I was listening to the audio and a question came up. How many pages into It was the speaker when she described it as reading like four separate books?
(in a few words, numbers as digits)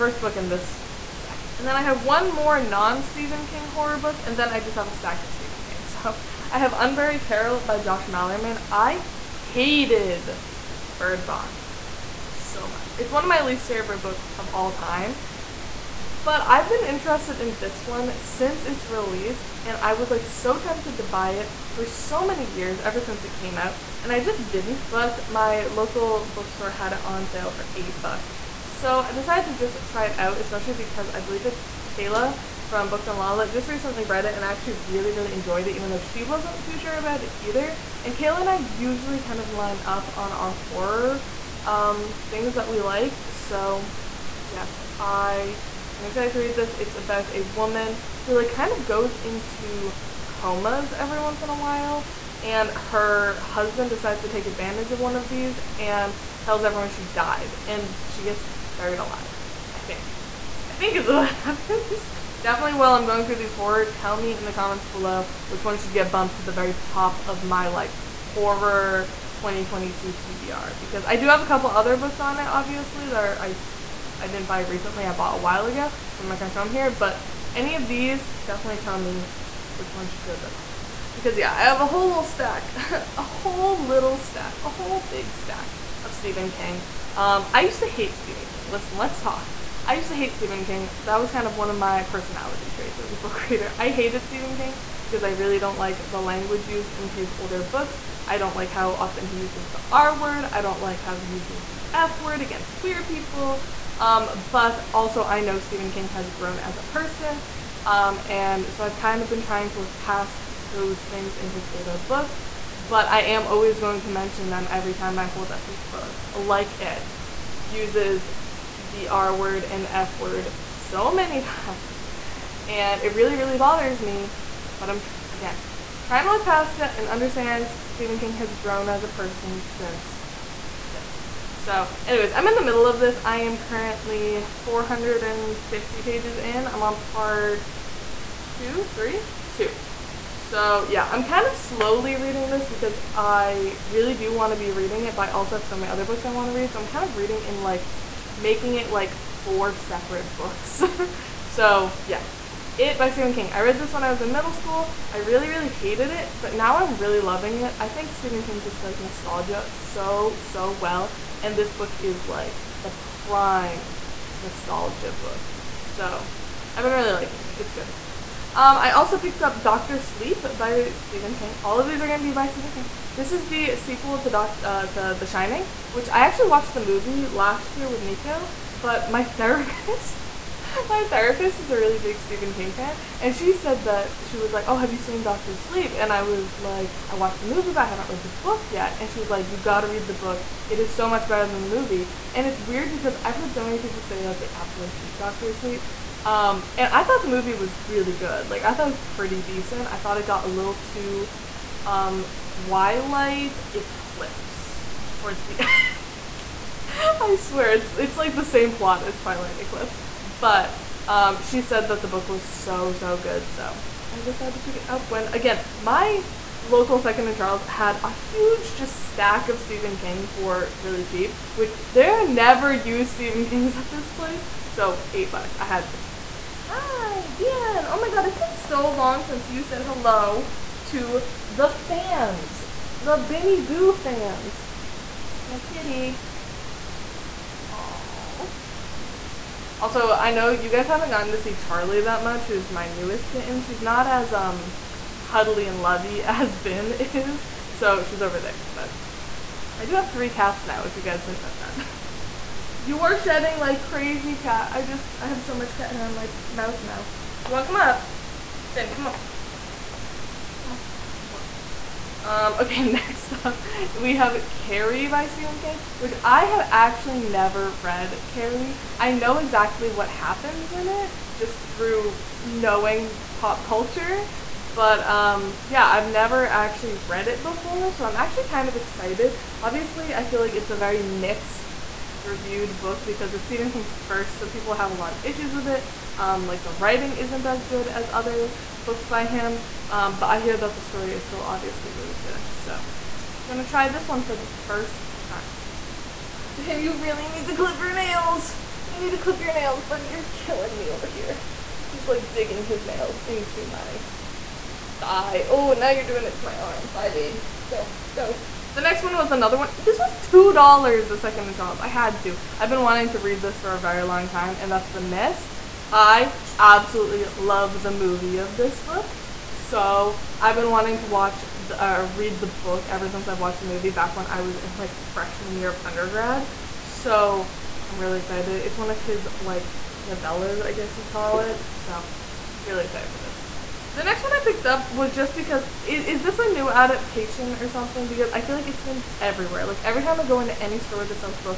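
450.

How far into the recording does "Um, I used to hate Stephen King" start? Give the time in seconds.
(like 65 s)
87 s.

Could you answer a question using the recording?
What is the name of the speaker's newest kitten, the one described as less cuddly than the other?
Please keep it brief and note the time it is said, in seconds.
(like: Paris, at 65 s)
Charlie, at 241 s.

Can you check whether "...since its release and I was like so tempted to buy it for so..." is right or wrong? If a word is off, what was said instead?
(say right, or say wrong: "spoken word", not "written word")
right.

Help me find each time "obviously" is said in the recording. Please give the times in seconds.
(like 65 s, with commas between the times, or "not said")
72 s, 279 s, 291 s.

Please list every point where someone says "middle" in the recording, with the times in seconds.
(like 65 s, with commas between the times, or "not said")
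132 s, 154 s.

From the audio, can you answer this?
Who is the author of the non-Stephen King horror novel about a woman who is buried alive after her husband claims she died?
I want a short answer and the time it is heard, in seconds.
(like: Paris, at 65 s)
Josh Malerman, at 7 s.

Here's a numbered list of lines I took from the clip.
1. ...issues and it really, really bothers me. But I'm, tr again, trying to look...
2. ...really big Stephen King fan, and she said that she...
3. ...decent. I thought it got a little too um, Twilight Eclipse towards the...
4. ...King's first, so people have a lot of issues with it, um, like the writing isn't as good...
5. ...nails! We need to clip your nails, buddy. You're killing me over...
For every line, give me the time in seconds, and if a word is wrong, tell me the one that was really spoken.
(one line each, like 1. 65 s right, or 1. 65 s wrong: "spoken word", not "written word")
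1. 121 s wrong: "times", not "issues"
2. 181 s right
3. 199 s right
4. 283 s right
5. 297 s right.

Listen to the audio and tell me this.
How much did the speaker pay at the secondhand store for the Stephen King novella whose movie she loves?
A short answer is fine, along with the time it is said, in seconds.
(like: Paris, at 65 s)
$2, at 310 s.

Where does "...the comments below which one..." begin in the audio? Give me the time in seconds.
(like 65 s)
64 s.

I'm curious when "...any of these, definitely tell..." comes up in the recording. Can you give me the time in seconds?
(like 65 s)
77 s.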